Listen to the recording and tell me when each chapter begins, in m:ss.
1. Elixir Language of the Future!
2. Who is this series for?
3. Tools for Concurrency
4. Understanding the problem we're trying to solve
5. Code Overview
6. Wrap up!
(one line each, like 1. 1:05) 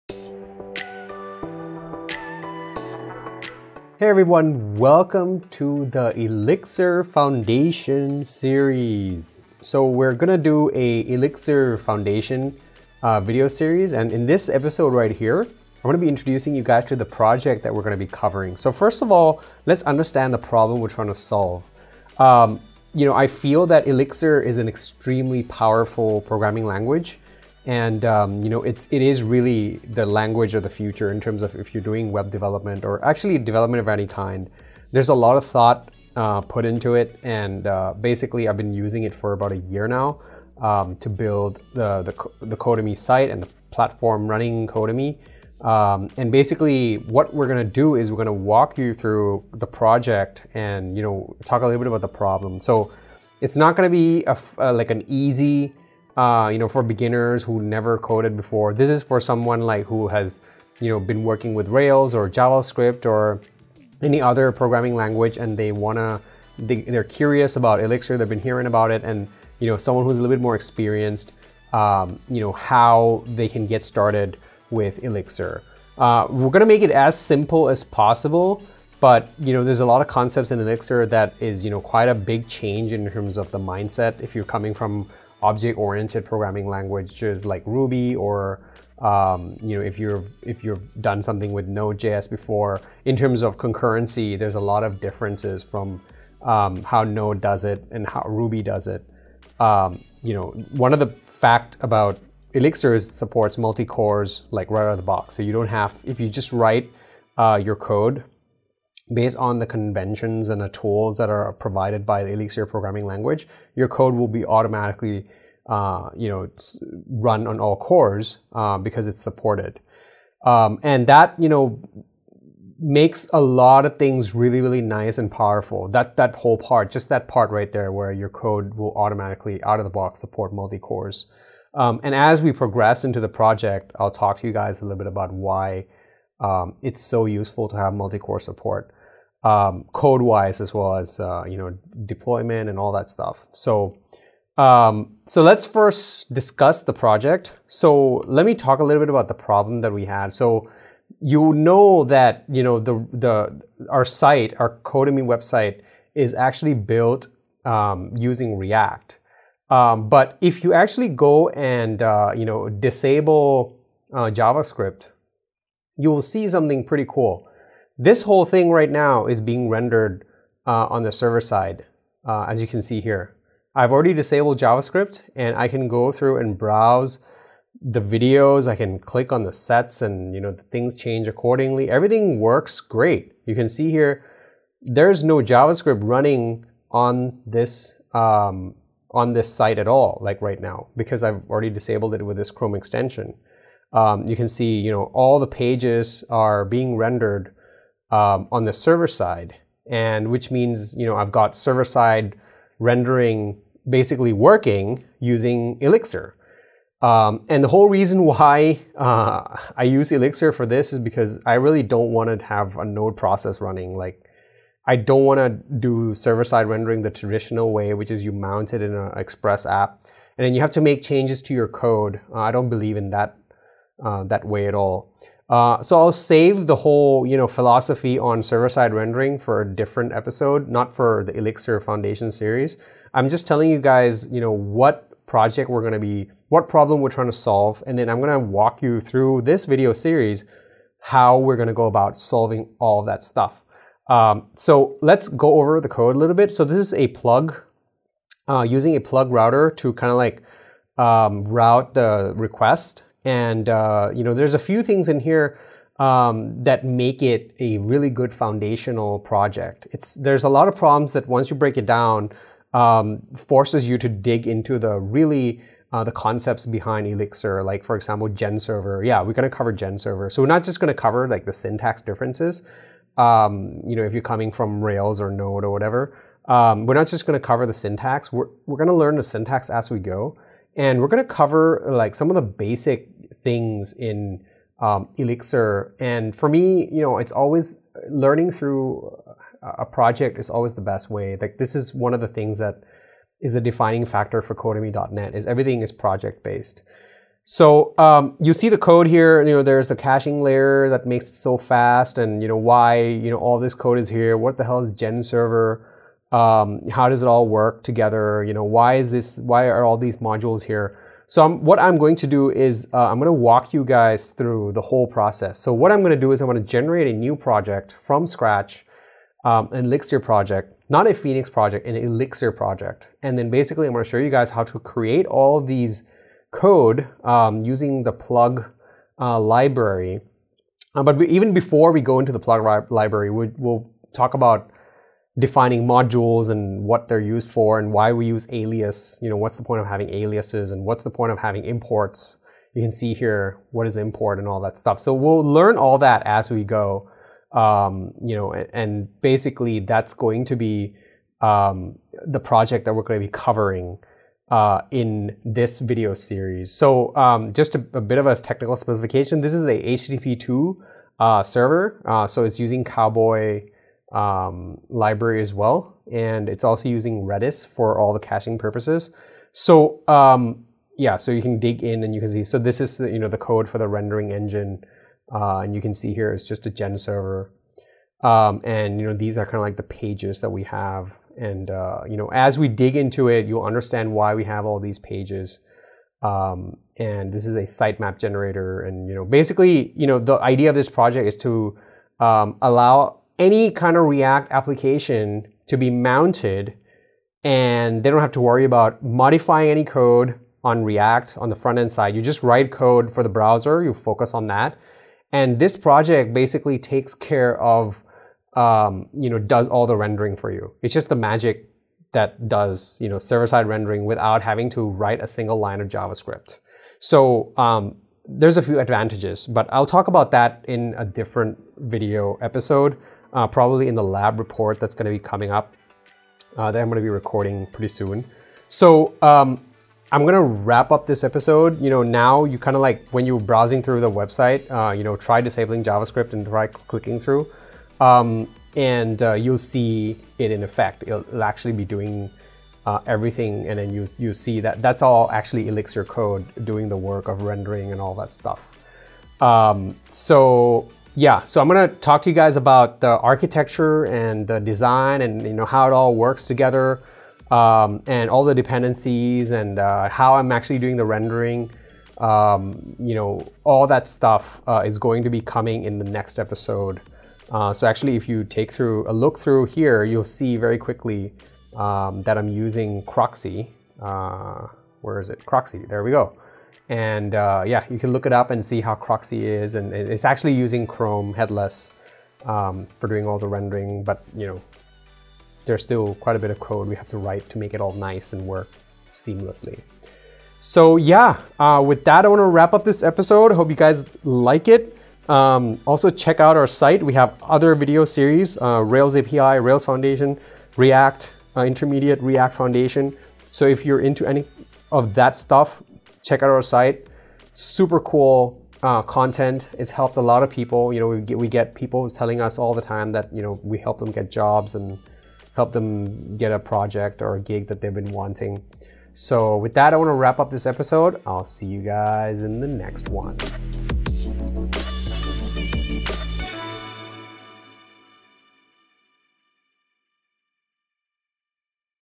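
1. 0:30
2. 0:54
3. 1:59
4. 2:32
5. 4:09
6. 7:09.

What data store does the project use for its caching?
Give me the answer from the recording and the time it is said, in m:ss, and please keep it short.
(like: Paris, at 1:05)
Redis, at 6:07.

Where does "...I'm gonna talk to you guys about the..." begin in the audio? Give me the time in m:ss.
7:31.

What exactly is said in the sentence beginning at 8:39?
So with that, I want to wrap up this episode.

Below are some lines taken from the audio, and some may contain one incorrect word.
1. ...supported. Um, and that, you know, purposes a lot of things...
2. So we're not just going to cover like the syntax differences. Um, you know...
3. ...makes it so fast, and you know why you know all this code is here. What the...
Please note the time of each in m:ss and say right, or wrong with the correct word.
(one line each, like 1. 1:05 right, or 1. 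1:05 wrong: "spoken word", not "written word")
1. 1:59 wrong: "makes", not "purposes"
2. 4:30 right
3. 5:01 right.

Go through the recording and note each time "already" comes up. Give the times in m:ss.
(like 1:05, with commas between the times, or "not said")
2:53, 3:11.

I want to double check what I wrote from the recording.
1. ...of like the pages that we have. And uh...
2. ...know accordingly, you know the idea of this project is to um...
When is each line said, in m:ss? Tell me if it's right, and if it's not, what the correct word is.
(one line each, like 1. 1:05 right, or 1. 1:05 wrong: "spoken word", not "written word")
1. 6:19 right
2. 6:29 wrong: "basically", not "accordingly".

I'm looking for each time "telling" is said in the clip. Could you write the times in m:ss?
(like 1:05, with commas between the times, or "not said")
3:53, 8:32.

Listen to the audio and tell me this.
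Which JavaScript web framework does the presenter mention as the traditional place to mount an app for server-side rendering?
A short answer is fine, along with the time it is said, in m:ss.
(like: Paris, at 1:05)
Express, at 3:39.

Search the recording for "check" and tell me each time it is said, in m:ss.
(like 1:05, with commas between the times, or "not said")
8:16, 8:26.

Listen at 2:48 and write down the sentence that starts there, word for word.
This whole thing right now is being rendered uh, on the server side, uh, as you can see here.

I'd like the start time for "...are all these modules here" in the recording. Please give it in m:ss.
5:09.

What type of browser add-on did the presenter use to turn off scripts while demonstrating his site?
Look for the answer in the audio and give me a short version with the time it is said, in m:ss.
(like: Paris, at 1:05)
Chrome extension, at 3:12.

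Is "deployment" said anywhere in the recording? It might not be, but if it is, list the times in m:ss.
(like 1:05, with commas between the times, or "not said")
2:22.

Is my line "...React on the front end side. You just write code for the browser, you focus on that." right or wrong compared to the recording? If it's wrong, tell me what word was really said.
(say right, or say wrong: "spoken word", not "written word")
right.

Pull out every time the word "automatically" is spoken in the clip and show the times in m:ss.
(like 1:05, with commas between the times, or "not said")
1:54, 2:08.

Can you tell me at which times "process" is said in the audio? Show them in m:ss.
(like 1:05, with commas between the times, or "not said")
3:33, 5:15.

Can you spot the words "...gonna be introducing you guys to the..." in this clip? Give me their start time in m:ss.
0:15.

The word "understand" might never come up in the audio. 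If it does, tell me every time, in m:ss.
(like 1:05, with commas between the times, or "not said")
0:19, 6:23.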